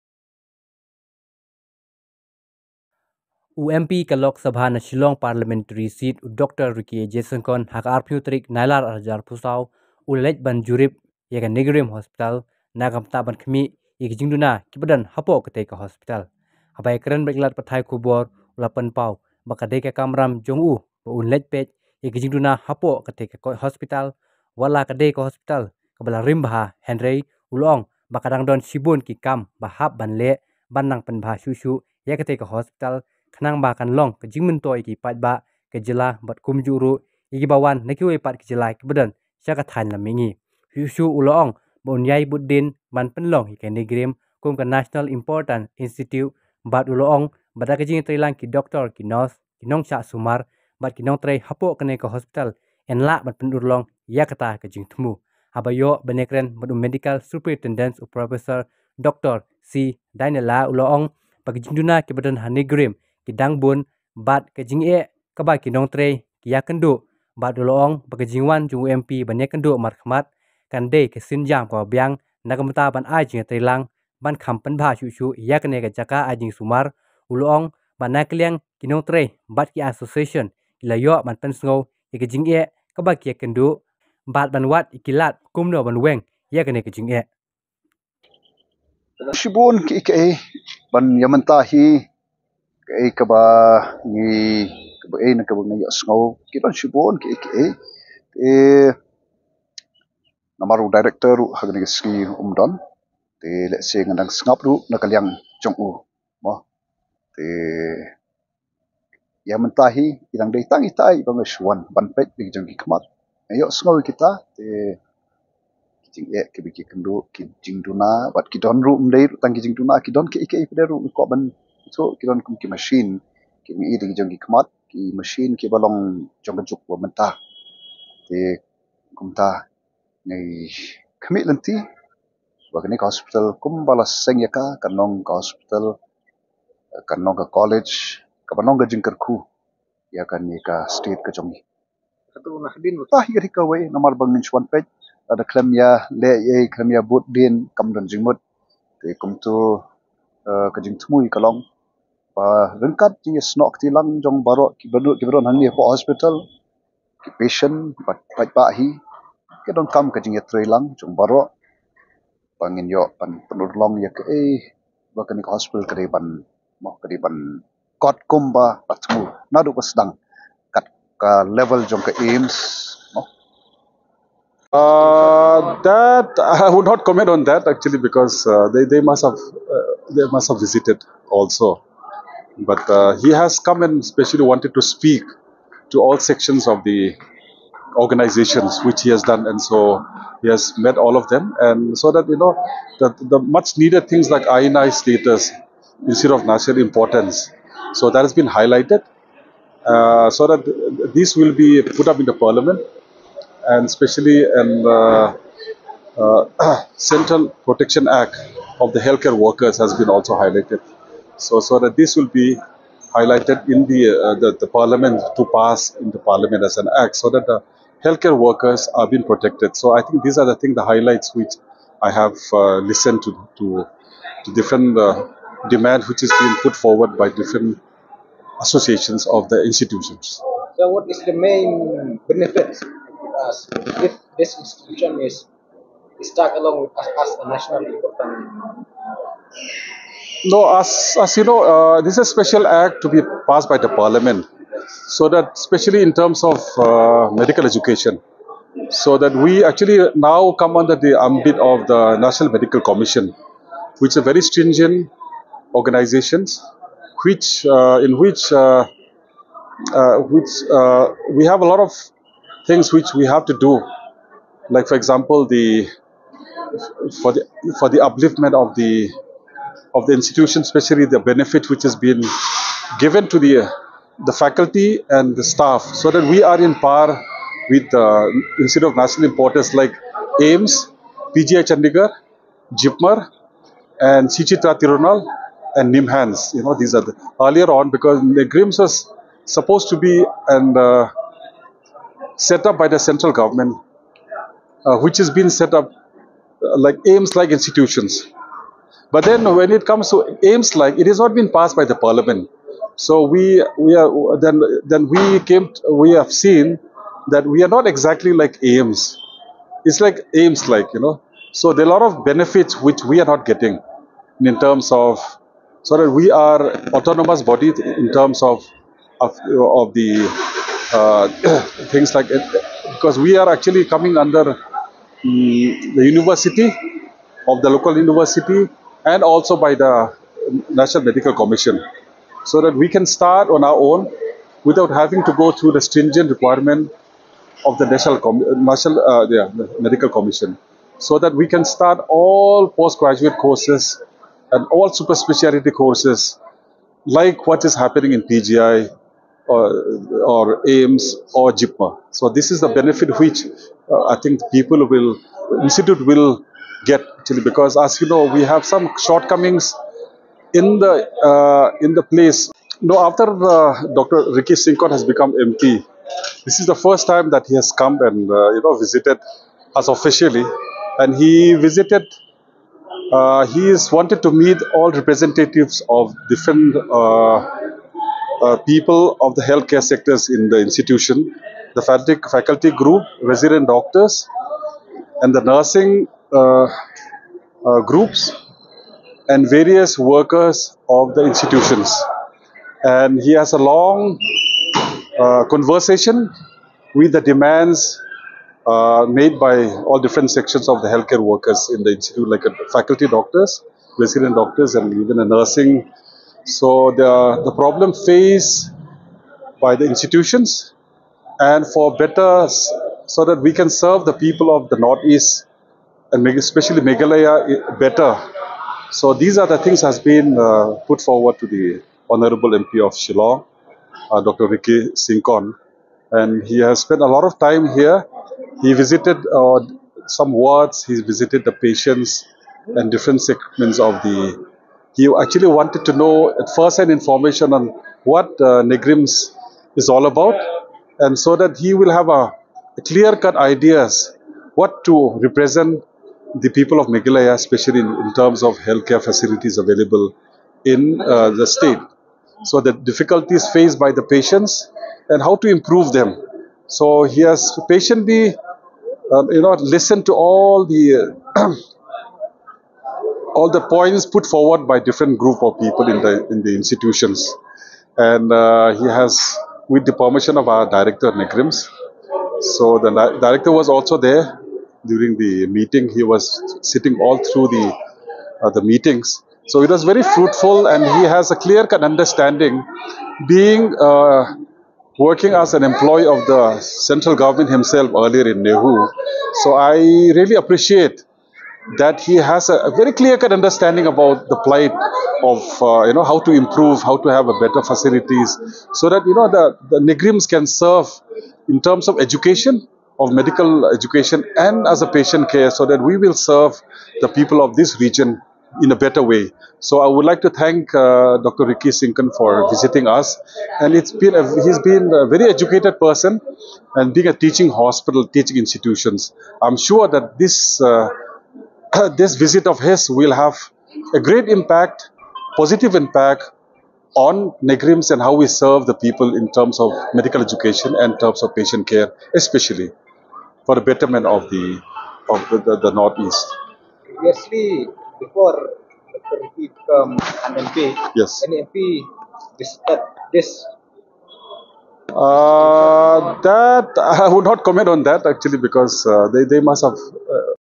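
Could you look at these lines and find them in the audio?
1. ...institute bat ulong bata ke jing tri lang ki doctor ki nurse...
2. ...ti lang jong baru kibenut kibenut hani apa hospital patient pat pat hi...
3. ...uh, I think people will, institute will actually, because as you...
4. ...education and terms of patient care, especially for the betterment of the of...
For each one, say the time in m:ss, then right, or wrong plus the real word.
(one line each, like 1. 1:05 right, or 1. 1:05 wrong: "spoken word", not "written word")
1. 0:45 right
2. 2:33 right
3. 5:53 right
4. 8:50 right.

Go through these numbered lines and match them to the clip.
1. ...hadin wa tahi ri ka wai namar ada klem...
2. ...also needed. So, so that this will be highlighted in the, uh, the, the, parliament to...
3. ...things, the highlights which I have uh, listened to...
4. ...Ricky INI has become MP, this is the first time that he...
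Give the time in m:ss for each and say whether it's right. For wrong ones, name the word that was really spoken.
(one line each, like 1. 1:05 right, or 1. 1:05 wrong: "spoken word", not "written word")
1. 2:22 right
2. 3:30 wrong: "highlighted", not "needed"
3. 3:40 right
4. 6:04 wrong: "Syngkon", not "INI".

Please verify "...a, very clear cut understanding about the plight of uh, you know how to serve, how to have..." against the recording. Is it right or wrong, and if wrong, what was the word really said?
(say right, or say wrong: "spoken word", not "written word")
wrong: "improve", not "serve".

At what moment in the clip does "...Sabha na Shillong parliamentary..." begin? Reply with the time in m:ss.
0:04.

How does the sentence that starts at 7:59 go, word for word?
So it was very fruitful, and he has a clear cut understanding.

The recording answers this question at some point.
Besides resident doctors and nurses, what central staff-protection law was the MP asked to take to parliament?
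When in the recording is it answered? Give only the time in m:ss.
3:26.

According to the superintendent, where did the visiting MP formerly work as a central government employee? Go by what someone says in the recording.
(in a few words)
NEHU.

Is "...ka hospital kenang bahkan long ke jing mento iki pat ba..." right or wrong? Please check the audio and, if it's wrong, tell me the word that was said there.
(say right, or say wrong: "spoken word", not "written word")
right.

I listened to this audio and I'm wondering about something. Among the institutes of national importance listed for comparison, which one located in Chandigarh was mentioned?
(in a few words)
PGI Chandigarh.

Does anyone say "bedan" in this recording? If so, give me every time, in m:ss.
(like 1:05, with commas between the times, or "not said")
0:38, 1:02.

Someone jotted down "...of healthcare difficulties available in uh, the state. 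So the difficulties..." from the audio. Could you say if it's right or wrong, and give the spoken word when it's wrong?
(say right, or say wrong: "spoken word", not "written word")
wrong: "facilities", not "difficulties".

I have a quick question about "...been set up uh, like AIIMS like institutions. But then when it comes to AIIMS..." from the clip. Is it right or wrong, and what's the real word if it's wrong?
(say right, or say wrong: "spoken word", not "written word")
right.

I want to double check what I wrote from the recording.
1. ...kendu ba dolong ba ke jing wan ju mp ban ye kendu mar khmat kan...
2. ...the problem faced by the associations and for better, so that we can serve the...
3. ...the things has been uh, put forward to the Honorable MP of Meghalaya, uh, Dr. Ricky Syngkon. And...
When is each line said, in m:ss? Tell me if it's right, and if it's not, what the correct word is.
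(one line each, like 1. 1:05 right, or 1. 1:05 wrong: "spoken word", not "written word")
1. 1:06 right
2. 6:47 wrong: "institutions", not "associations"
3. 6:59 wrong: "Shillong", not "Meghalaya".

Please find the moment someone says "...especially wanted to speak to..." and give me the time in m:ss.
3:04.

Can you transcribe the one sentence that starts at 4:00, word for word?
No, as, as you know, uh, this is a special act to be passed by the parliament.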